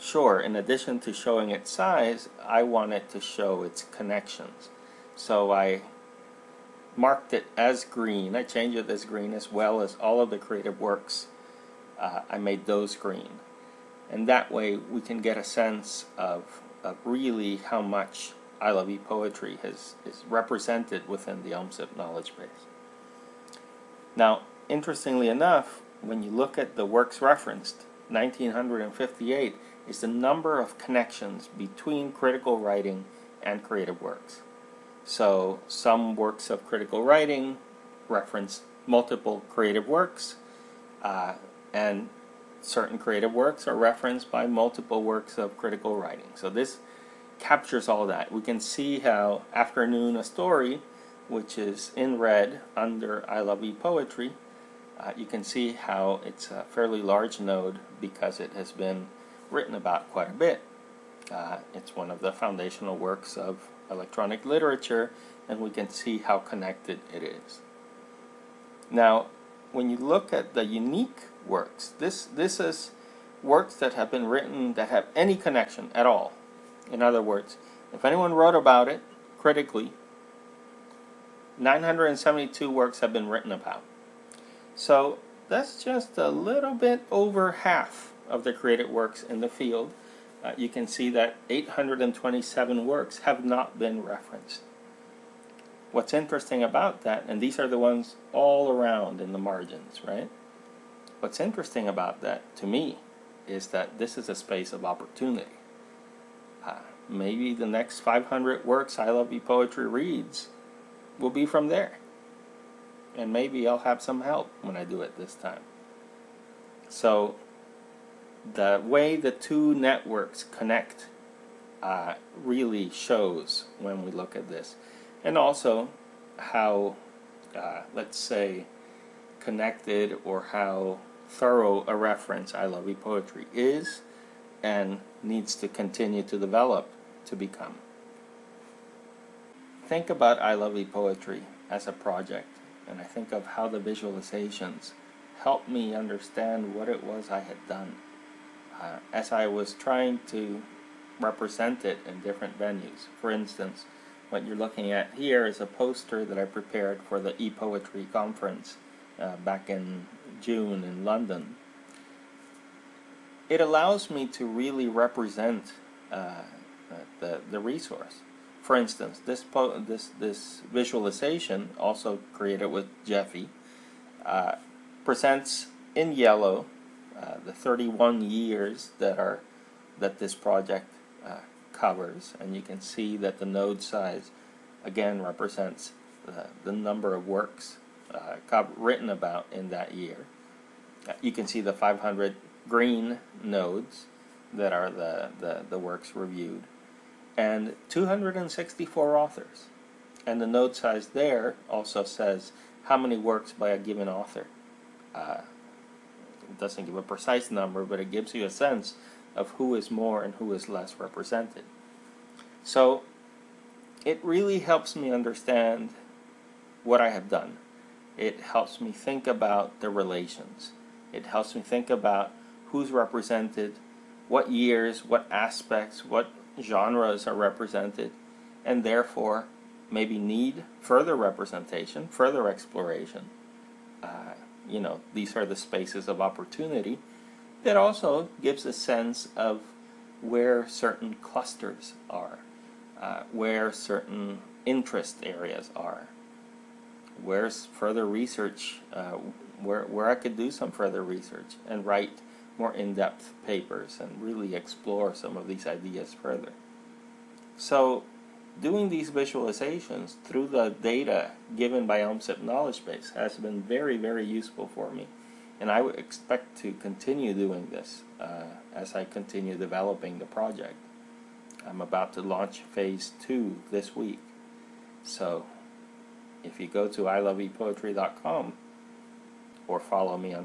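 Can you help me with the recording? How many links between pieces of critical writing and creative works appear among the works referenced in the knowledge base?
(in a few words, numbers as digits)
1958.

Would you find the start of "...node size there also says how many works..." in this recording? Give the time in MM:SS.
03:20.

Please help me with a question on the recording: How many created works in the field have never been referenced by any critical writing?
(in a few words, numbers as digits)
827.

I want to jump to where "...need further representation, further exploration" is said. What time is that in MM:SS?
03:50.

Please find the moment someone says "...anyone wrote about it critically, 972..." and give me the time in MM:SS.
01:18.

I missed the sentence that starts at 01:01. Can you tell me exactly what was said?
Uh, it's one of the foundational works of electronic literature and we can see how connected it is.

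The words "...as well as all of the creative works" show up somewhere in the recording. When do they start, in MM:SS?
00:09.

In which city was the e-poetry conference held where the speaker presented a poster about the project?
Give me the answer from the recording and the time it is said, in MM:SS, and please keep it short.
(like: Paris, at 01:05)
London, at 02:41.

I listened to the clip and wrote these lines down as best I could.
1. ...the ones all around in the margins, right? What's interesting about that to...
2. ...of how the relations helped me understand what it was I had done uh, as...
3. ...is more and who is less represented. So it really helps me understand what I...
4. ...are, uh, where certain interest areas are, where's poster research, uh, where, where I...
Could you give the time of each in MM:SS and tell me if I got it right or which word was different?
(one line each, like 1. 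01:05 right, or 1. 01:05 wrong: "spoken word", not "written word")
1. 01:37 right
2. 02:23 wrong: "visualizations", not "relations"
3. 03:29 right
4. 04:02 wrong: "further", not "poster".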